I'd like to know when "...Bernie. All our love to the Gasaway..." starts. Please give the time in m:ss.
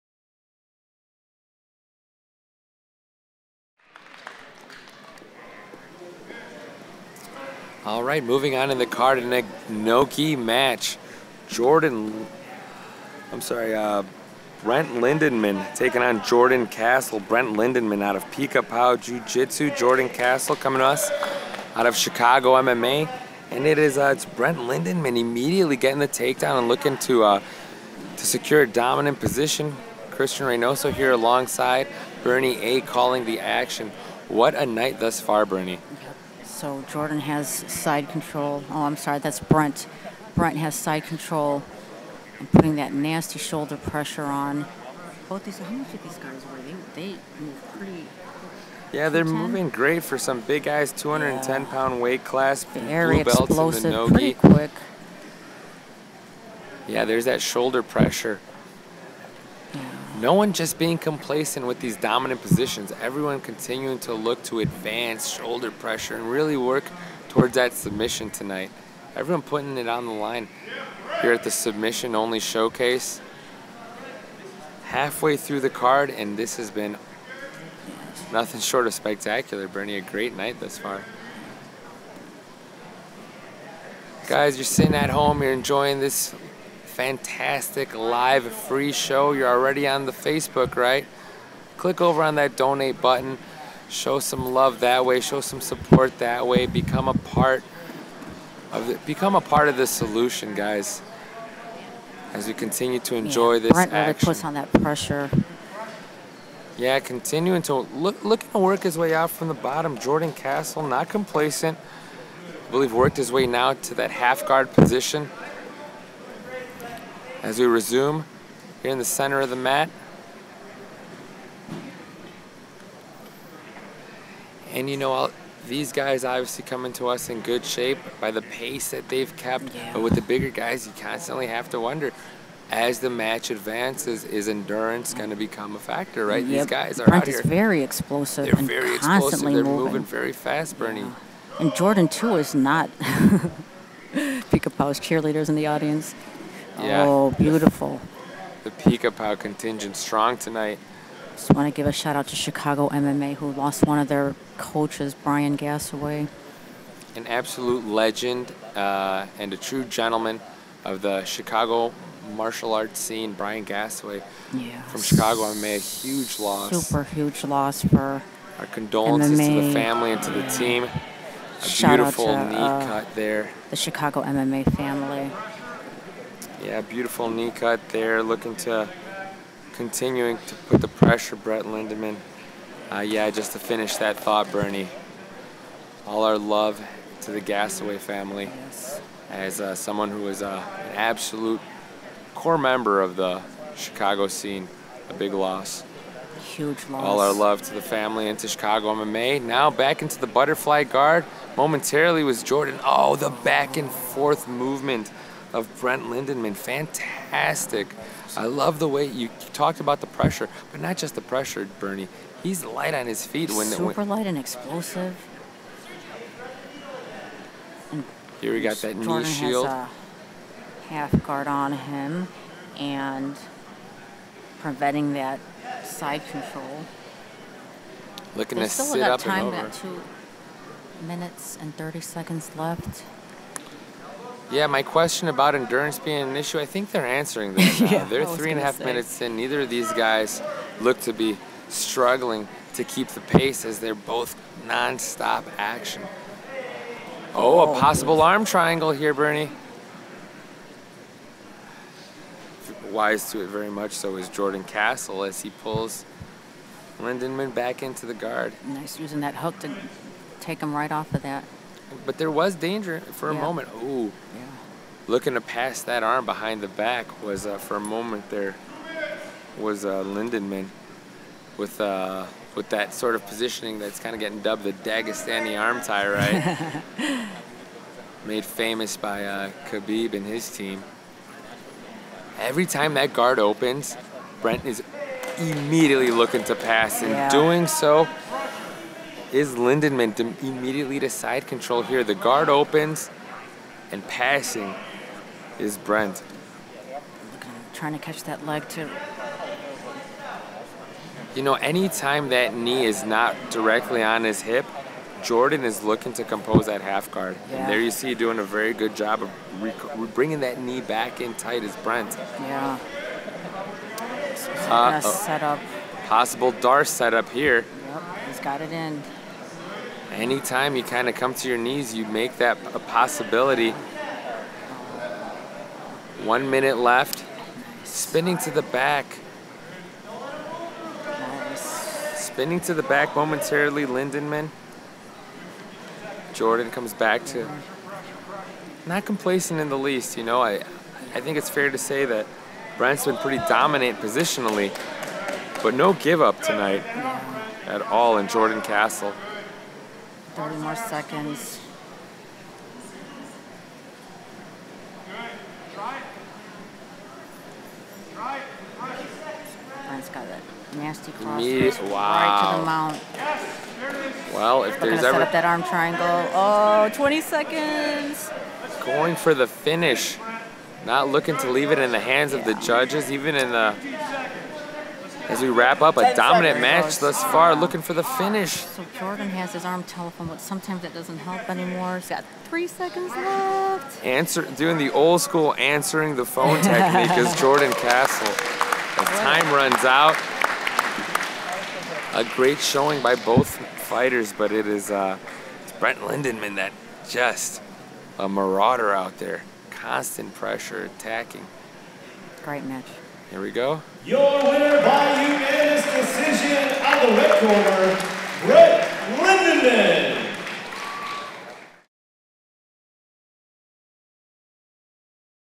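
3:04.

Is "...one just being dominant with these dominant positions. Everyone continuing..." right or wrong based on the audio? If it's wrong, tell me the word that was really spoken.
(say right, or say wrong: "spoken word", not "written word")
wrong: "complacent", not "dominant".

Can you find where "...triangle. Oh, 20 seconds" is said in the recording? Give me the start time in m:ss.
6:05.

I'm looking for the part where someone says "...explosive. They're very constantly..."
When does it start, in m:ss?
2:17.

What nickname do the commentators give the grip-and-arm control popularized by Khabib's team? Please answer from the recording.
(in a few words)
Dagestani arm tie.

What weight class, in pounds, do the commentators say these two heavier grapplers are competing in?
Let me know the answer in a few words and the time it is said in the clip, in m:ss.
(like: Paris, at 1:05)
210, at 0:50.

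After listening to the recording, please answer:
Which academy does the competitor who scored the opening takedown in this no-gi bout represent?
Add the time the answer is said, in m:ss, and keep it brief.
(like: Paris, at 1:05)
Pica Pau Jiu Jitsu, at 0:18.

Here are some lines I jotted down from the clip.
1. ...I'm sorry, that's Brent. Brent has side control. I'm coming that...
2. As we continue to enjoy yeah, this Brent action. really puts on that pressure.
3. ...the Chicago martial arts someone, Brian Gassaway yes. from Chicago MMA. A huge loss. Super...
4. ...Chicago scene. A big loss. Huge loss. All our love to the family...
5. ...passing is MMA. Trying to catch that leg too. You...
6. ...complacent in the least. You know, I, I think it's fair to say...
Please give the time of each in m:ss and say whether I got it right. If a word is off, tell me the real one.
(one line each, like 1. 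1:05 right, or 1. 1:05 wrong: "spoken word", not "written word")
1. 0:38 wrong: "putting", not "coming"
2. 1:42 right
3. 2:41 wrong: "scene", not "someone"
4. 3:13 right
5. 4:54 wrong: "Brent", not "MMA"
6. 5:39 right.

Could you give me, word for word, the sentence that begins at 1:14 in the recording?
Halfway through the card, and this has been nothing short of spectacular, Bernie.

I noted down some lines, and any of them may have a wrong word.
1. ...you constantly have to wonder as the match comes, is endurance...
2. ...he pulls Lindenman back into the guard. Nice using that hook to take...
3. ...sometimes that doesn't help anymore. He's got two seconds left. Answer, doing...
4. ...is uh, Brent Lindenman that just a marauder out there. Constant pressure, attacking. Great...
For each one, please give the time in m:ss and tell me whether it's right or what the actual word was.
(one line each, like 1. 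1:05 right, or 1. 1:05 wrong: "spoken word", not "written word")
1. 2:10 wrong: "advances", not "comes"
2. 4:15 right
3. 6:20 wrong: "three", not "two"
4. 6:34 right.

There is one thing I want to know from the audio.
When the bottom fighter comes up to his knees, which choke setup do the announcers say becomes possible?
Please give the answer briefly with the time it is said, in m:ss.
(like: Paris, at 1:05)
D'Arce, at 5:16.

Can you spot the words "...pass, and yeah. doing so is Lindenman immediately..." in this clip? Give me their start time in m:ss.
4:46.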